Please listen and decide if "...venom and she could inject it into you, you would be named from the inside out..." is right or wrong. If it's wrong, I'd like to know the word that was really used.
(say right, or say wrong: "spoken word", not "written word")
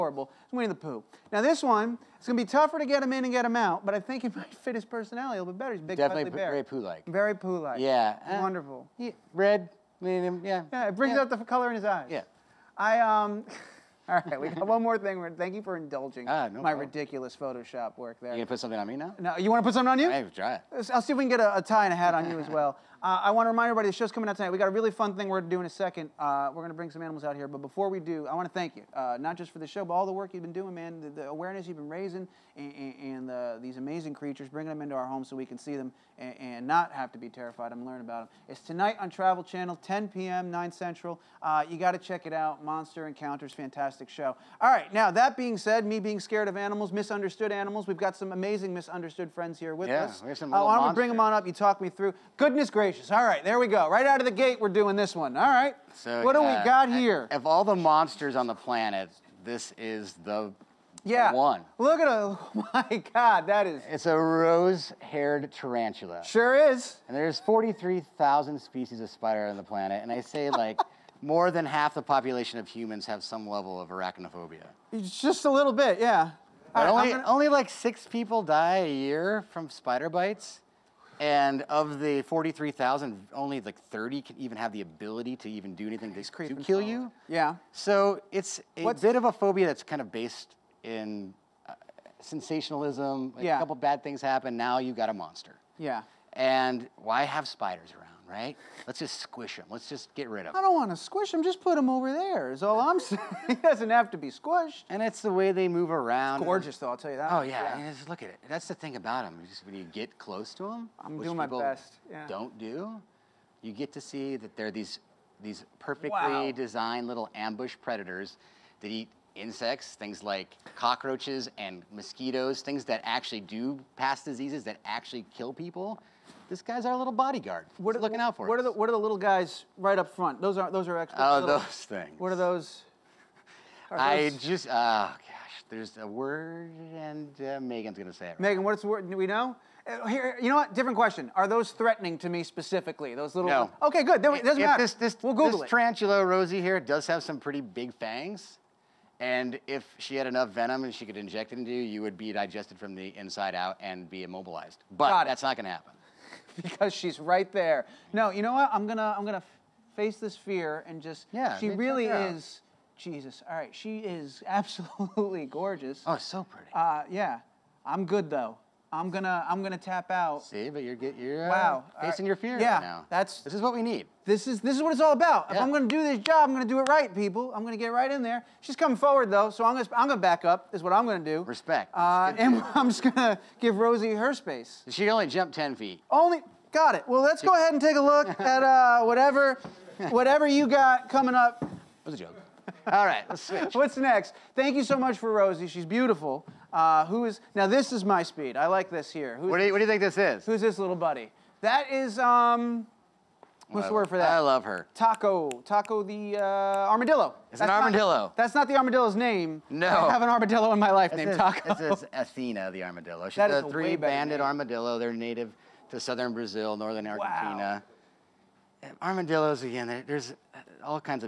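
wrong: "digested", not "named".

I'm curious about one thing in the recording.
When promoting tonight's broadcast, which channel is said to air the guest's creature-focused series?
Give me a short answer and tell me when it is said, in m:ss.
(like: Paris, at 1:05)
Travel Channel, at 0:39.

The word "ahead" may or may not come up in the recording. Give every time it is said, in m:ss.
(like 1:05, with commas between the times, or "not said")
3:07.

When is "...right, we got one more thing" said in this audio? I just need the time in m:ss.
0:14.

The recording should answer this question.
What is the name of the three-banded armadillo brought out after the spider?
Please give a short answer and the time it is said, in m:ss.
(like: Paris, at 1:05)
Athena, at 3:32.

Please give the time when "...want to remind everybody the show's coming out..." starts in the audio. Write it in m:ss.
0:23.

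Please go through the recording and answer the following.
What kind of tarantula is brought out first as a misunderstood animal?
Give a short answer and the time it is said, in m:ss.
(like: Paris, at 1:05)
Rose-haired tarantula, at 1:04.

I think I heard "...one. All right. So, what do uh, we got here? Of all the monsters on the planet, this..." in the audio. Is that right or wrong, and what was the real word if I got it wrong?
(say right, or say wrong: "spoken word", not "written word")
right.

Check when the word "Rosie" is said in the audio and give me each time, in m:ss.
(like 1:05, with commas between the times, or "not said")
2:26, 3:03, 3:15.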